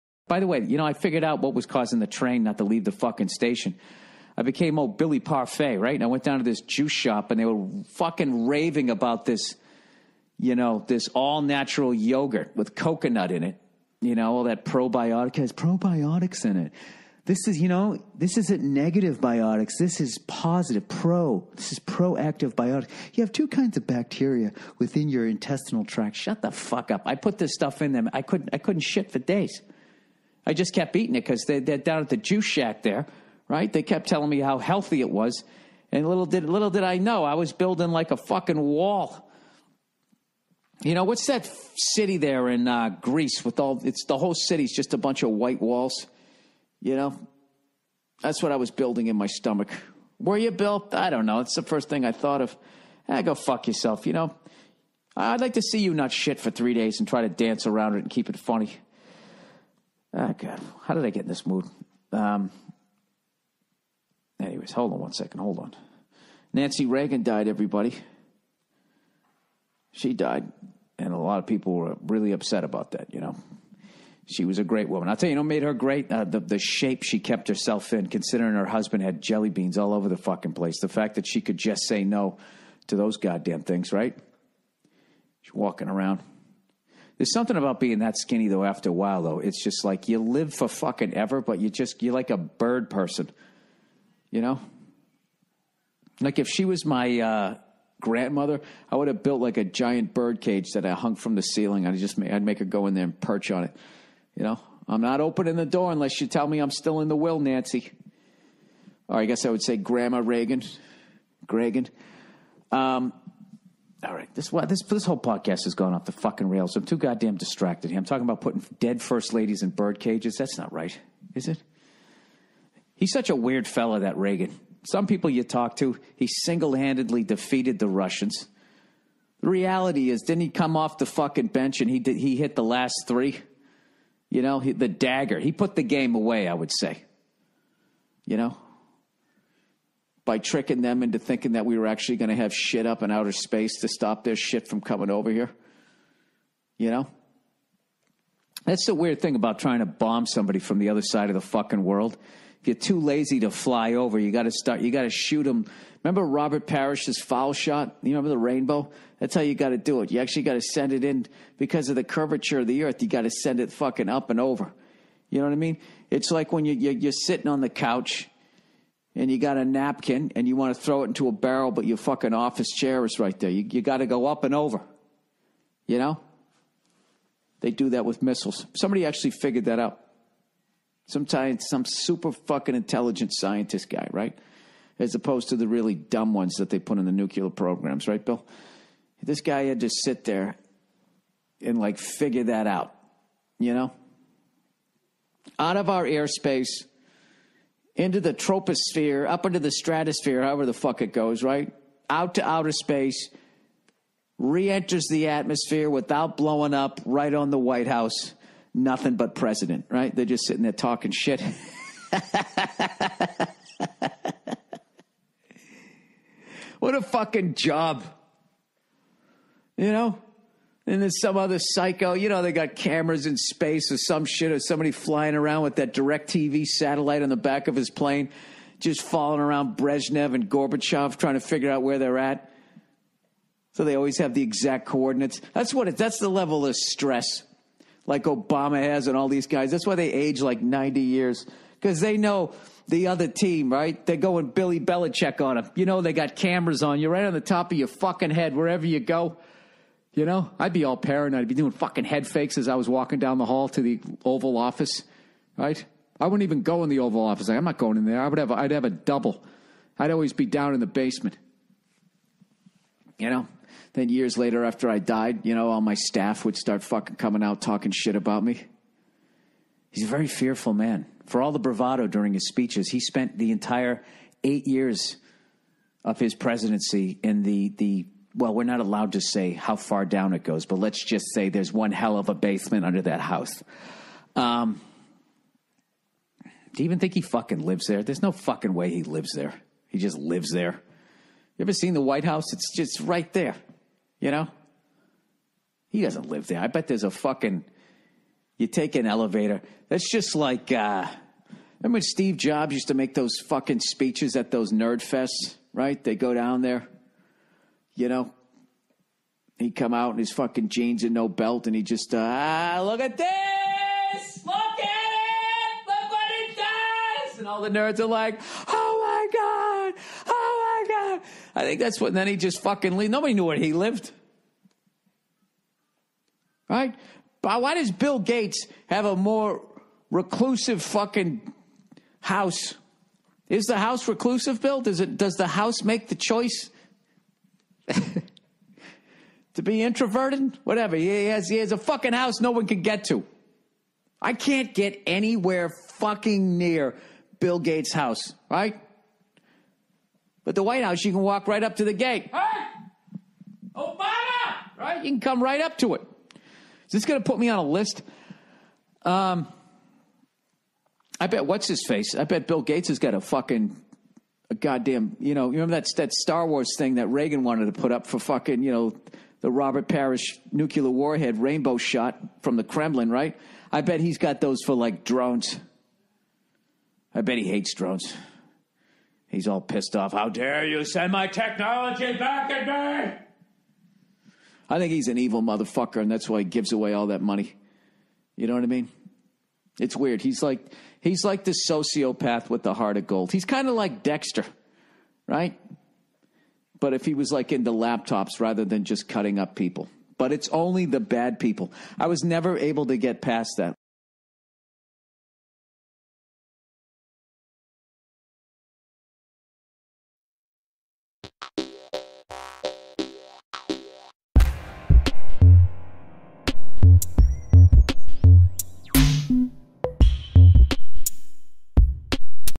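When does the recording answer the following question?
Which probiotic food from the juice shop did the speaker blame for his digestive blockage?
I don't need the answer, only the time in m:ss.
0:11.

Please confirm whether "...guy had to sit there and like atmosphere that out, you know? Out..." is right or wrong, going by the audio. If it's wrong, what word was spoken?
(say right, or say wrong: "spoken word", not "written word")
wrong: "figure", not "atmosphere".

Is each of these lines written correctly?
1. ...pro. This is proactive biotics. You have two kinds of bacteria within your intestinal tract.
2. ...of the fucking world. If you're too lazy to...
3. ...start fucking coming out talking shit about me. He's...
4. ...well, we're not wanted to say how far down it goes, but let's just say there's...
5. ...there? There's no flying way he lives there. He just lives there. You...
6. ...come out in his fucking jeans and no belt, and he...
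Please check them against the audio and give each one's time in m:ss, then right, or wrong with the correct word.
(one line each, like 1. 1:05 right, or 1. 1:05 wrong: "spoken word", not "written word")
1. 0:20 right
2. 2:31 right
3. 4:26 right
4. 4:38 wrong: "allowed", not "wanted"
5. 4:47 wrong: "fucking", not "flying"
6. 5:09 right.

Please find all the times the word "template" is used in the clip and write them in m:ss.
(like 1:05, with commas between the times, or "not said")
not said.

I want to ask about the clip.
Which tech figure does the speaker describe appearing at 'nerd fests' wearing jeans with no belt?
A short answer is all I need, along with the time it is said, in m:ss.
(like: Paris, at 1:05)
Steve Jobs, at 5:01.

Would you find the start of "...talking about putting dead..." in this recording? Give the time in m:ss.
1:58.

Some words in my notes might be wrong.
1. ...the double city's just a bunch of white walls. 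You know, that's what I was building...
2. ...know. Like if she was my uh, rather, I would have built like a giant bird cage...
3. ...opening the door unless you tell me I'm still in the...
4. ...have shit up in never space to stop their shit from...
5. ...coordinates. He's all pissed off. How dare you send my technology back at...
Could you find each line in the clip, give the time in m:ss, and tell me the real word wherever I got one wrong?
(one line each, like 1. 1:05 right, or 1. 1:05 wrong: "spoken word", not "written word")
1. 0:44 wrong: "whole", not "double"
2. 1:34 wrong: "grandmother", not "rather"
3. 1:45 right
4. 2:22 wrong: "outer", not "never"
5. 6:17 wrong: "drones", not "coordinates".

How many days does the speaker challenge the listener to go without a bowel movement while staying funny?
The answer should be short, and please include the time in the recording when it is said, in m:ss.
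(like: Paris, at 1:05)
3, at 0:56.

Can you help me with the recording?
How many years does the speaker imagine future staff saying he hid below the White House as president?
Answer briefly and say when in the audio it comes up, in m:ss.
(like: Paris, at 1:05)
8, at 4:34.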